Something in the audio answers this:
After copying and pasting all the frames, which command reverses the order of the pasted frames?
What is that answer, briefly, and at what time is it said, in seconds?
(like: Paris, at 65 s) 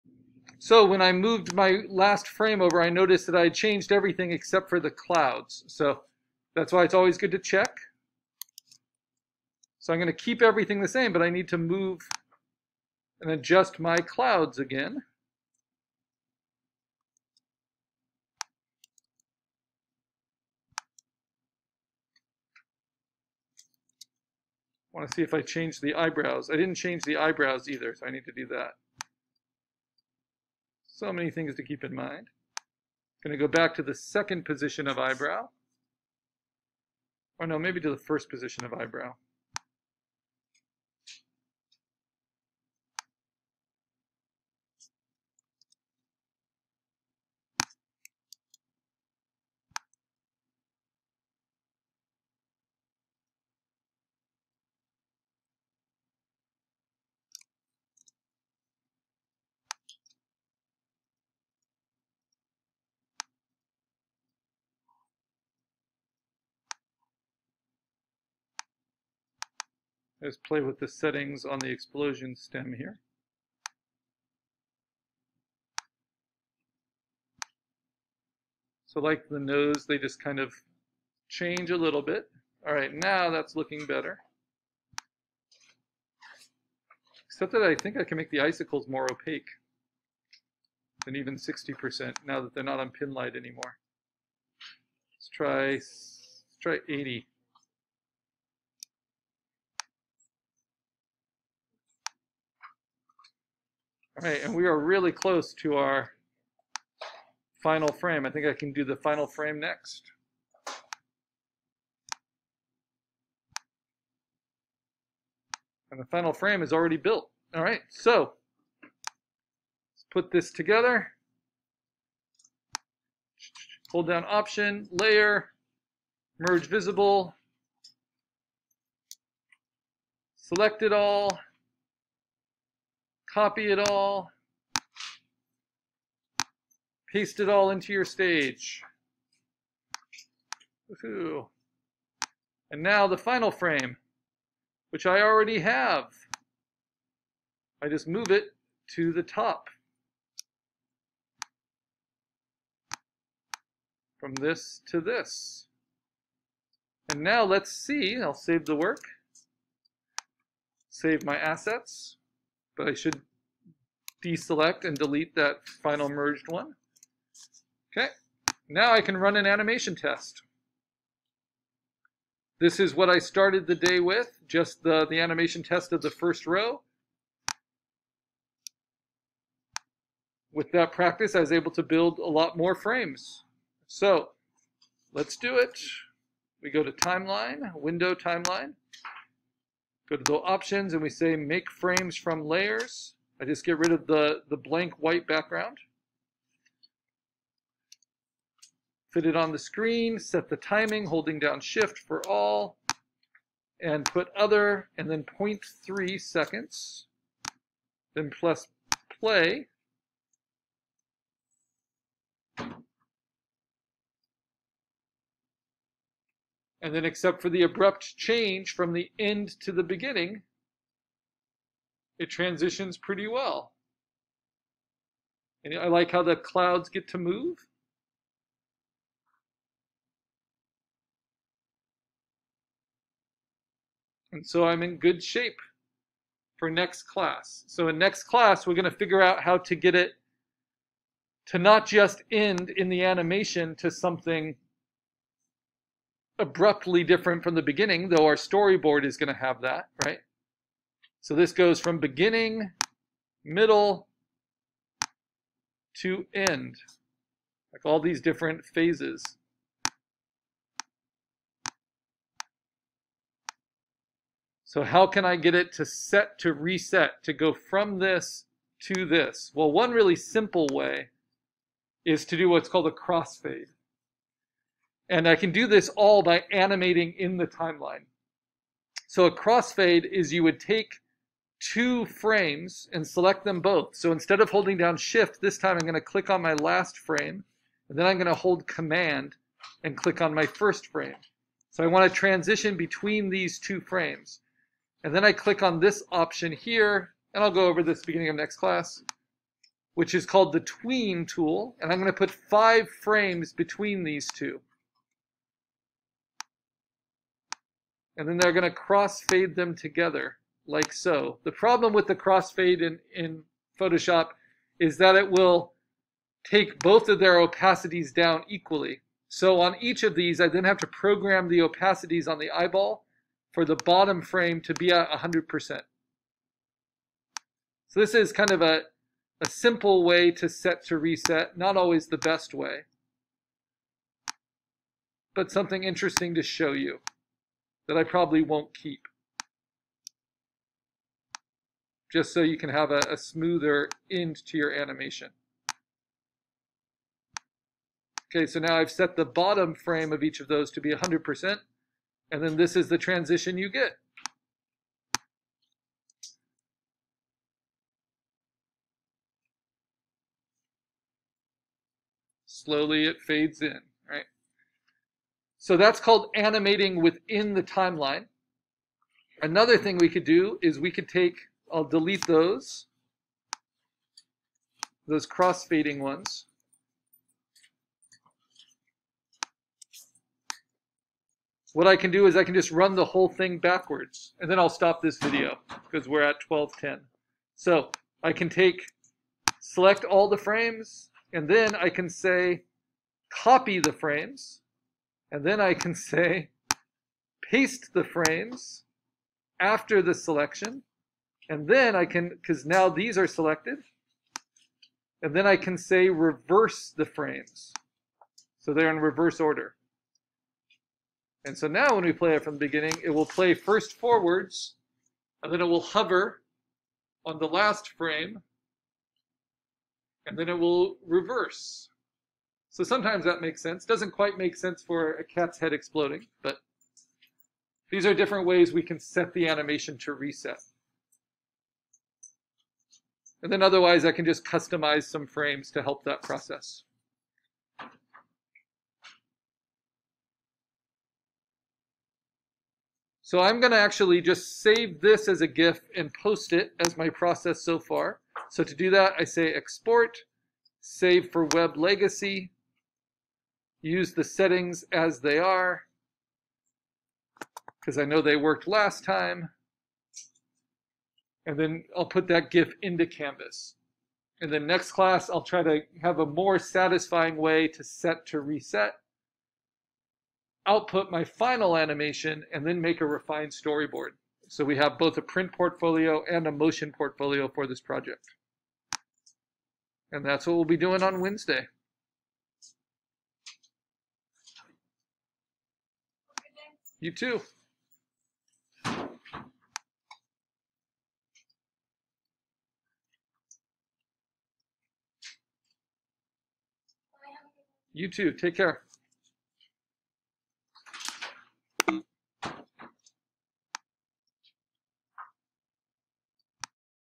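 reverse the frames, at 406 s.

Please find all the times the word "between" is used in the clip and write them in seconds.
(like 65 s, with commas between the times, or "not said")
292 s, 303 s.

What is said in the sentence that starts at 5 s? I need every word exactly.
So that's why it's always good to check.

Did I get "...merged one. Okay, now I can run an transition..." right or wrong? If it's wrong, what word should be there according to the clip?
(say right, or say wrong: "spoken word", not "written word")
wrong: "animation", not "transition".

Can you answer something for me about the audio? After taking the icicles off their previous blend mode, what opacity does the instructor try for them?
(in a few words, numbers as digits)
80%.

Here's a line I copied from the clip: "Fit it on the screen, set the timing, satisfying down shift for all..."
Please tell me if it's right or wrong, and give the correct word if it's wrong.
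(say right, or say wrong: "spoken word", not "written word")
wrong: "holding", not "satisfying".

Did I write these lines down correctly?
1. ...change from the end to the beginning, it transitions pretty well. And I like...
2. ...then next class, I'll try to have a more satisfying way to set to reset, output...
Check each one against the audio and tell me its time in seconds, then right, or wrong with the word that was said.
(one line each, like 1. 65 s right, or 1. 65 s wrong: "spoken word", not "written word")
1. 218 s right
2. 464 s right.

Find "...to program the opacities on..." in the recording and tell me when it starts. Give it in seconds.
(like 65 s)
320 s.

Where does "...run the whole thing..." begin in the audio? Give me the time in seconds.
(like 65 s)
382 s.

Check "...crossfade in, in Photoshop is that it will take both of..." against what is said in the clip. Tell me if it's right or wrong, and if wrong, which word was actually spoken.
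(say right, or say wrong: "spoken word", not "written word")
right.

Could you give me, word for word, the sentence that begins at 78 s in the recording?
So like the nose, they just kind of change a little bit.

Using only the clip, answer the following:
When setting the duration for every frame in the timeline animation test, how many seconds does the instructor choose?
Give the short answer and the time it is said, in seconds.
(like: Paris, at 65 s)
0.3 seconds, at 205 s.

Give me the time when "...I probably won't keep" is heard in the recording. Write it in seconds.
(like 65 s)
337 s.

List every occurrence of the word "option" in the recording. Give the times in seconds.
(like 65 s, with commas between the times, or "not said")
124 s, 190 s, 296 s.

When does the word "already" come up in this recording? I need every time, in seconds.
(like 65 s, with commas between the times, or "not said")
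116 s, 145 s.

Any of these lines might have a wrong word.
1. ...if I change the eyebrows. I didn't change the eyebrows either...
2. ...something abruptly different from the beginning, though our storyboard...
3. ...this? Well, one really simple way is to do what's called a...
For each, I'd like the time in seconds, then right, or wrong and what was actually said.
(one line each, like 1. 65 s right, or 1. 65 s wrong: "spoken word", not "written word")
1. 25 s right
2. 243 s right
3. 269 s right.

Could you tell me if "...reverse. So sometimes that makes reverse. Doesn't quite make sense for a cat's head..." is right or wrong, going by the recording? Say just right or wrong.
wrong.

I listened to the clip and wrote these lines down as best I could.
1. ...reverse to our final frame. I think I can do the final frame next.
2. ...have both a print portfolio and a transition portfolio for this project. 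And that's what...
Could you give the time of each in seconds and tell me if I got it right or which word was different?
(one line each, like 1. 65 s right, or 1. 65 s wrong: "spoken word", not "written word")
1. 105 s wrong: "close", not "reverse"
2. 474 s wrong: "motion", not "transition".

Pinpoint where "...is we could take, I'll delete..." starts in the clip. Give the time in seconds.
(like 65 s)
370 s.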